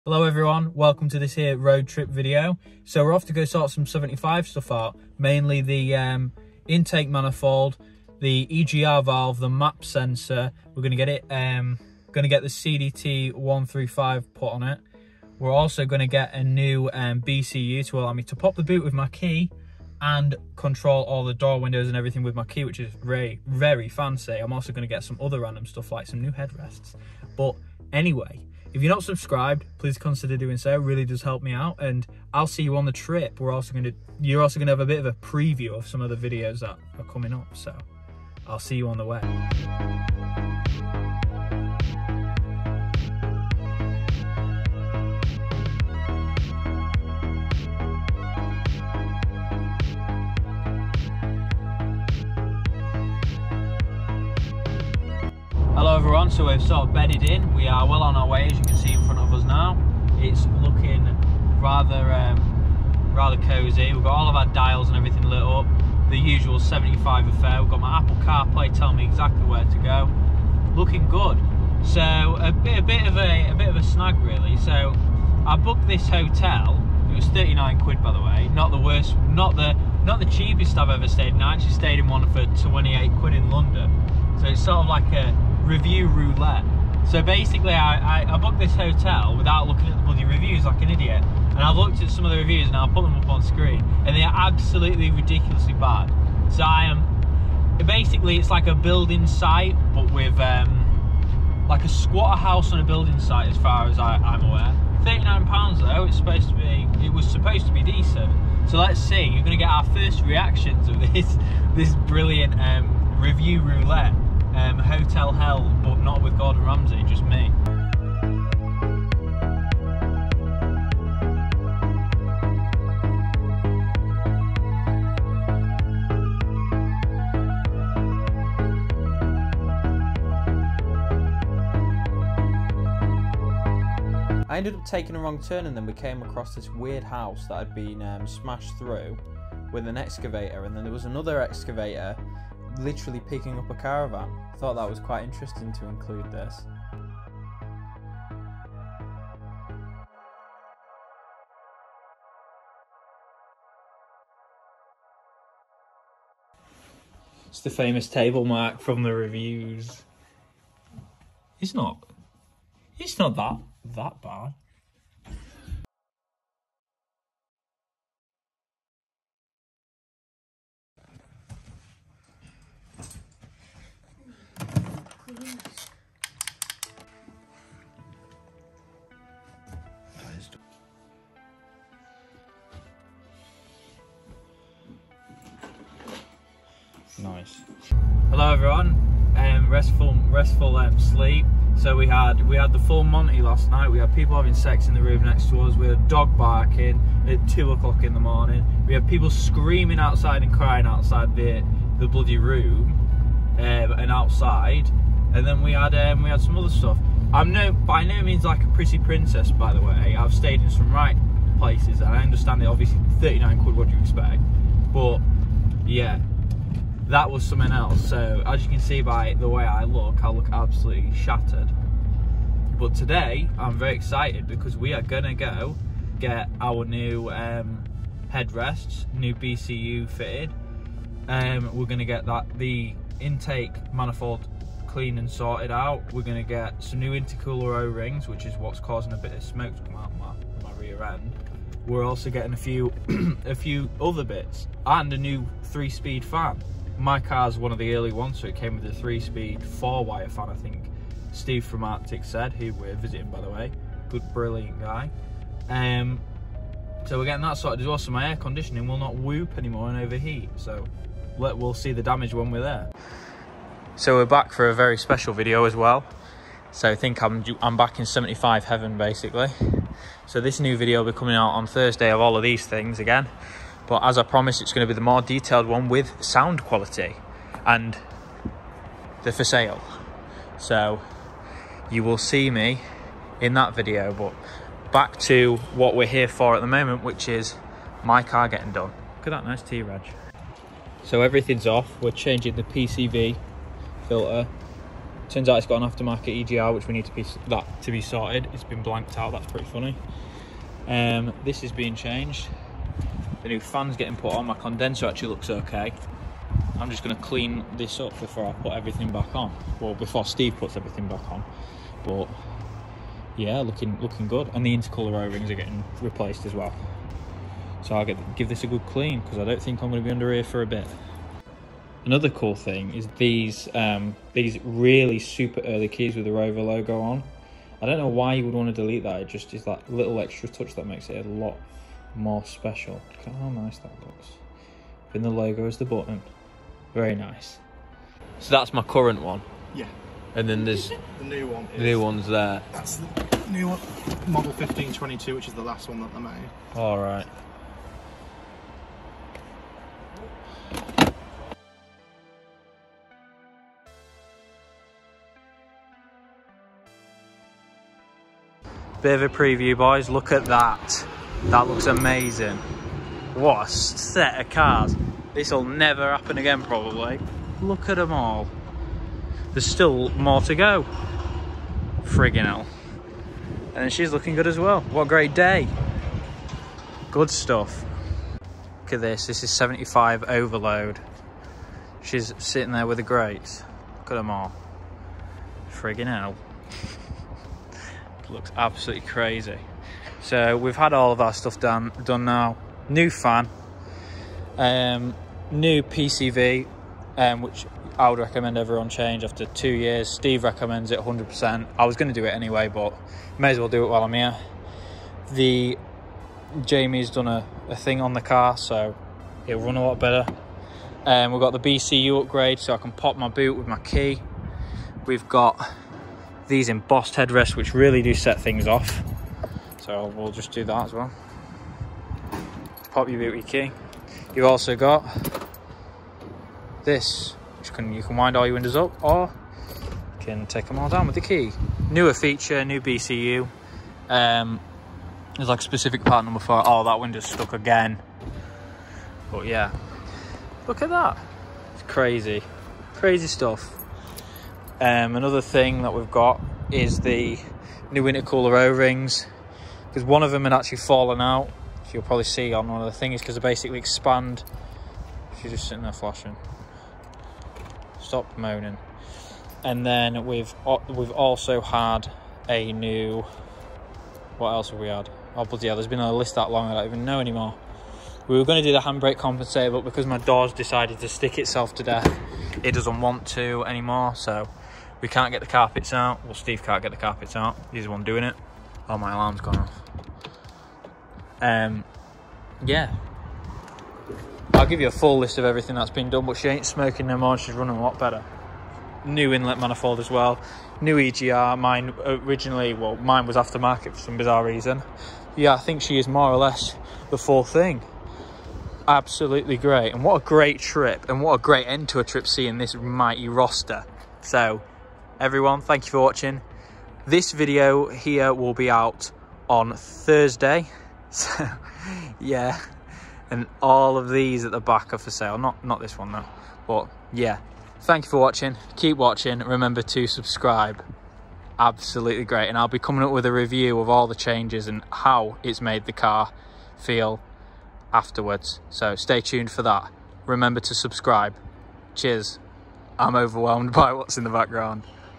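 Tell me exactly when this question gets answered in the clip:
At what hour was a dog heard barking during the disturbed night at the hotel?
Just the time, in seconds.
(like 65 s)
197 s.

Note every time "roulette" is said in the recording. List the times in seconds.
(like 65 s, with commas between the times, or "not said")
86 s, 113 s.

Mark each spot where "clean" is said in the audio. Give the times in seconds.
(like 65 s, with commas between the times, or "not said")
234 s, 307 s, 318 s.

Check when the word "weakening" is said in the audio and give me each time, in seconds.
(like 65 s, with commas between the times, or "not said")
not said.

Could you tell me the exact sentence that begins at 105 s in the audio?
39 pounds though, it's supposed to be, it was supposed to be decent.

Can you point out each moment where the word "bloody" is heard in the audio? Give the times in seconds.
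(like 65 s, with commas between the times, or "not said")
90 s, 202 s, 465 s.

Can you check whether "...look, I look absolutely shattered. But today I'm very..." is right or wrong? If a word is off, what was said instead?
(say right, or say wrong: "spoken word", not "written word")
right.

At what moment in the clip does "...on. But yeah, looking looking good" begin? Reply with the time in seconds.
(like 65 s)
311 s.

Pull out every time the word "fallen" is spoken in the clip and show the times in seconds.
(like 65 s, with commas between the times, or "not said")
450 s.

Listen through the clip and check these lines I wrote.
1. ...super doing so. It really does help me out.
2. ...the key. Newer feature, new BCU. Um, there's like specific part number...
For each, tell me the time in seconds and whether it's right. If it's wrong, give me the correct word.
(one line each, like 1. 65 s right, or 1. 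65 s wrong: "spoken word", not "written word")
1. 29 s wrong: "consider", not "super"
2. 431 s right.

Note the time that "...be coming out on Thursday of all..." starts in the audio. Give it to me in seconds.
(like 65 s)
271 s.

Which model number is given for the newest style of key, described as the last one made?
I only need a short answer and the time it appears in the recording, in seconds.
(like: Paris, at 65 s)
1522, at 344 s.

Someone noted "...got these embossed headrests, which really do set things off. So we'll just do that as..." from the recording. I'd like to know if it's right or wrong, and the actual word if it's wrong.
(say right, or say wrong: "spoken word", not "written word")
right.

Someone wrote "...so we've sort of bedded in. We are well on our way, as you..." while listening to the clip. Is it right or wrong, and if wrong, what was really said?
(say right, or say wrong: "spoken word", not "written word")
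right.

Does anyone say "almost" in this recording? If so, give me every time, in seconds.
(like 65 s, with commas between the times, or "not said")
not said.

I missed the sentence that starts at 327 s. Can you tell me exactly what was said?
I don't know why you would want to delete that.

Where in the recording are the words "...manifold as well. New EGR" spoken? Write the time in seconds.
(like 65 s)
489 s.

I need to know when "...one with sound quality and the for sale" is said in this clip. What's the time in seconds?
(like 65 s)
275 s.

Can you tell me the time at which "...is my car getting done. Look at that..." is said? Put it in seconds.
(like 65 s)
287 s.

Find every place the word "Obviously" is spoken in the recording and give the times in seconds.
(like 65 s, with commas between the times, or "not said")
212 s.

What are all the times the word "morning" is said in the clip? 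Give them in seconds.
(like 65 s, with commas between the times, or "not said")
198 s.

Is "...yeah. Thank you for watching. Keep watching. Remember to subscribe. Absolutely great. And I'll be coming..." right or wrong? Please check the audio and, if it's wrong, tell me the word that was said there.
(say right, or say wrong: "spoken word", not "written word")
right.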